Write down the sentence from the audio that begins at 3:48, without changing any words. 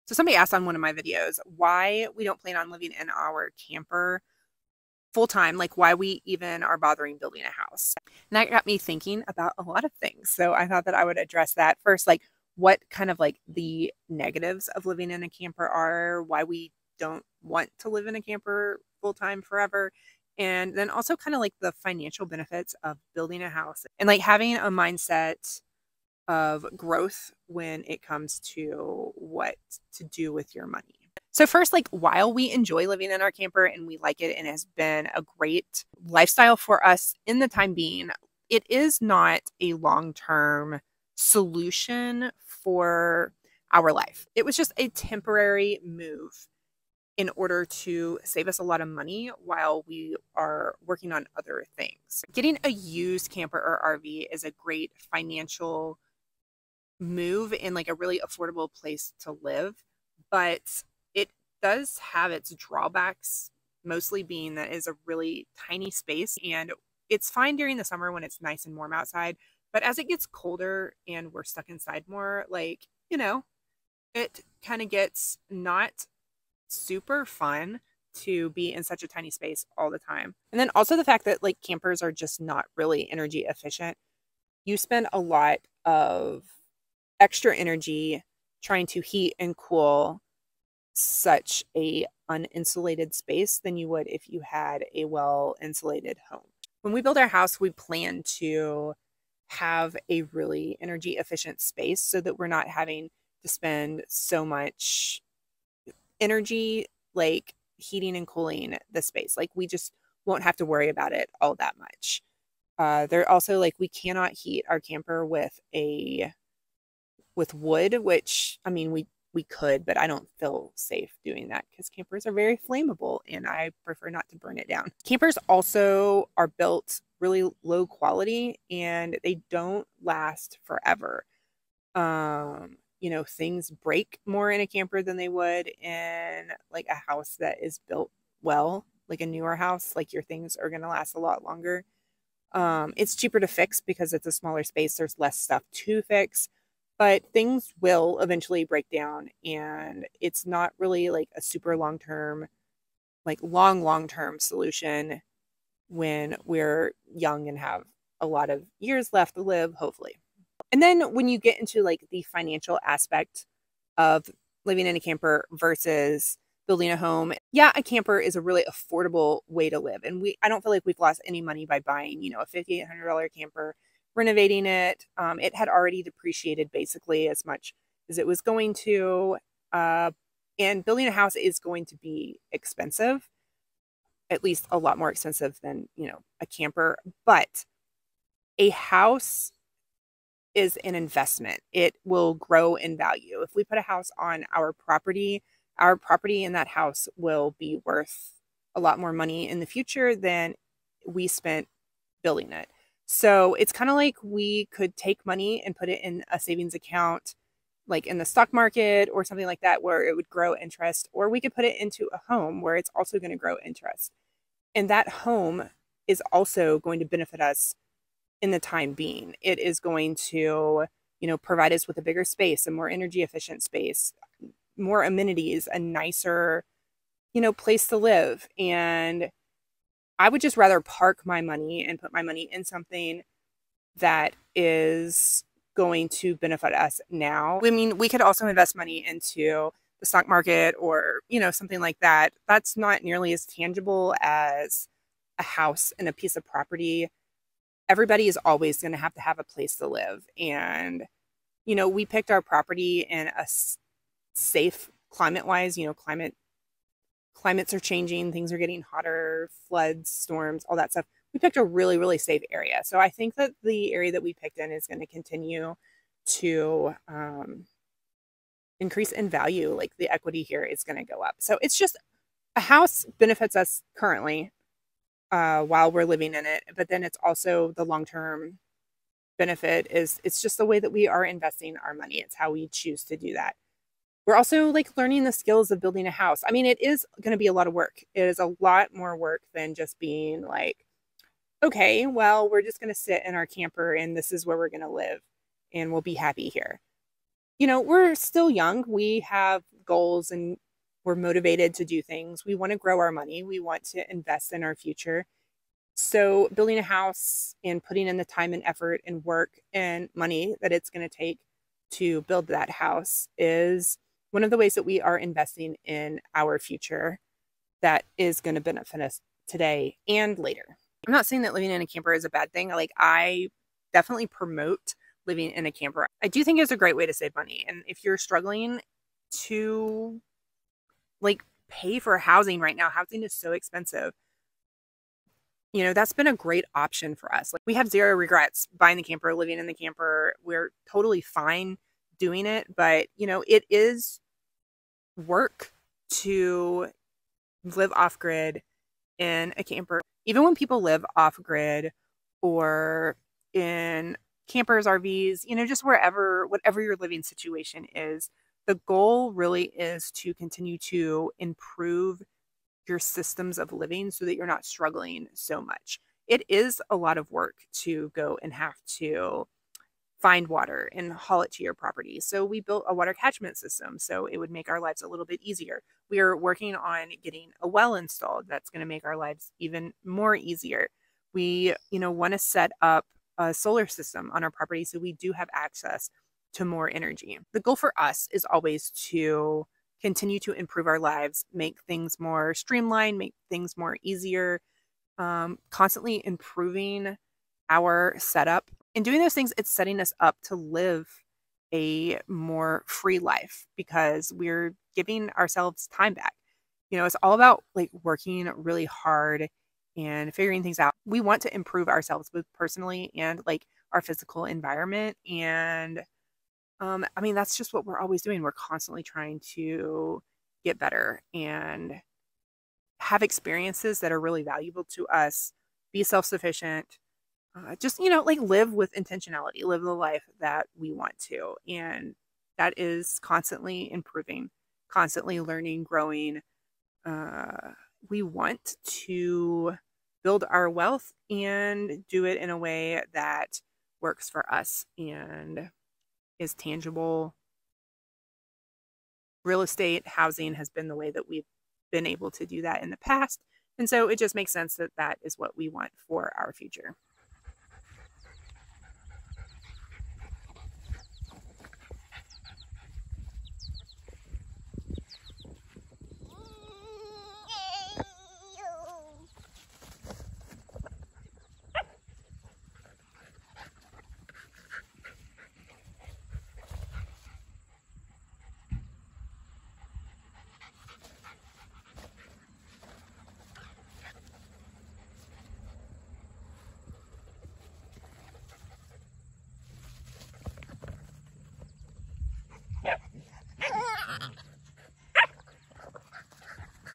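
And I would just rather park my money and put my money in something that is going to benefit us now.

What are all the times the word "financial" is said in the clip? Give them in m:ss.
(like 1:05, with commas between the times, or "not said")
0:21, 0:55, 2:42.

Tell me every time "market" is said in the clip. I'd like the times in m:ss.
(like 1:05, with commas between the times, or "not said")
3:28, 4:00.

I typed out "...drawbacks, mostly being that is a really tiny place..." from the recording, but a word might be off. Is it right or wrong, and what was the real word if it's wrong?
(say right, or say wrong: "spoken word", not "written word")
wrong: "space", not "place".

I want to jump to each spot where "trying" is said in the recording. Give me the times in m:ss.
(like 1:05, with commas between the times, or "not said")
1:28, 6:59.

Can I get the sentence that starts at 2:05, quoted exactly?
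Campers also are built really low quality and they don't last forever.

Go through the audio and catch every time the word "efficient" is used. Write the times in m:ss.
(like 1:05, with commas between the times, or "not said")
1:23, 1:41, 3:43.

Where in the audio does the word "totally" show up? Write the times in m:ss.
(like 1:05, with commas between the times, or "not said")
5:40.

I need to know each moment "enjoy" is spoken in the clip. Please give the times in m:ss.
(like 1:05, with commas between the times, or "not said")
0:32.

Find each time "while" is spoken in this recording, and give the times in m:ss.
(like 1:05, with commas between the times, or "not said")
0:31, 0:49, 4:35.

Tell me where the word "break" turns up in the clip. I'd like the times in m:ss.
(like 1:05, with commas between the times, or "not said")
2:13, 2:28.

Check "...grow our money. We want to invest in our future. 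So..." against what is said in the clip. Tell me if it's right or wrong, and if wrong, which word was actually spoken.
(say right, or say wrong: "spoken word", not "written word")
right.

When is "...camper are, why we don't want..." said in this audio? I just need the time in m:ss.
0:15.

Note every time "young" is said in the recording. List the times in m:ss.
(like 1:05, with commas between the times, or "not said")
2:37, 4:58.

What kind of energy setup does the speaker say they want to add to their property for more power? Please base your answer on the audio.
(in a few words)
solar system.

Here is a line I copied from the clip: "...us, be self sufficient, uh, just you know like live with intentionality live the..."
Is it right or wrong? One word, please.
right.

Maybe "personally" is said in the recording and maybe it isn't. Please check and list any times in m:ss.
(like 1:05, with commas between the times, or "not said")
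6:52.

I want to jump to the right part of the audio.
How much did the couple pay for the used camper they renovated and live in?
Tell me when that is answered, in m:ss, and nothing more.
2:52.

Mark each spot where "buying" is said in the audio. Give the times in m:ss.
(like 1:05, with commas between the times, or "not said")
2:51, 5:38.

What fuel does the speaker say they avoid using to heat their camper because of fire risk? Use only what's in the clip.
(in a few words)
wood.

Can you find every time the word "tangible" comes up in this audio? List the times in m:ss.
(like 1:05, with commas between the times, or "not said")
4:03, 7:26.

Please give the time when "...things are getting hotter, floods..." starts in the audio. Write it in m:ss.
4:18.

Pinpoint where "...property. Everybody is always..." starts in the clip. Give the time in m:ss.
4:06.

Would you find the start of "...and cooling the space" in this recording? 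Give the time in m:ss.
1:48.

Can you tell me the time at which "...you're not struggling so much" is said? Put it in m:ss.
6:04.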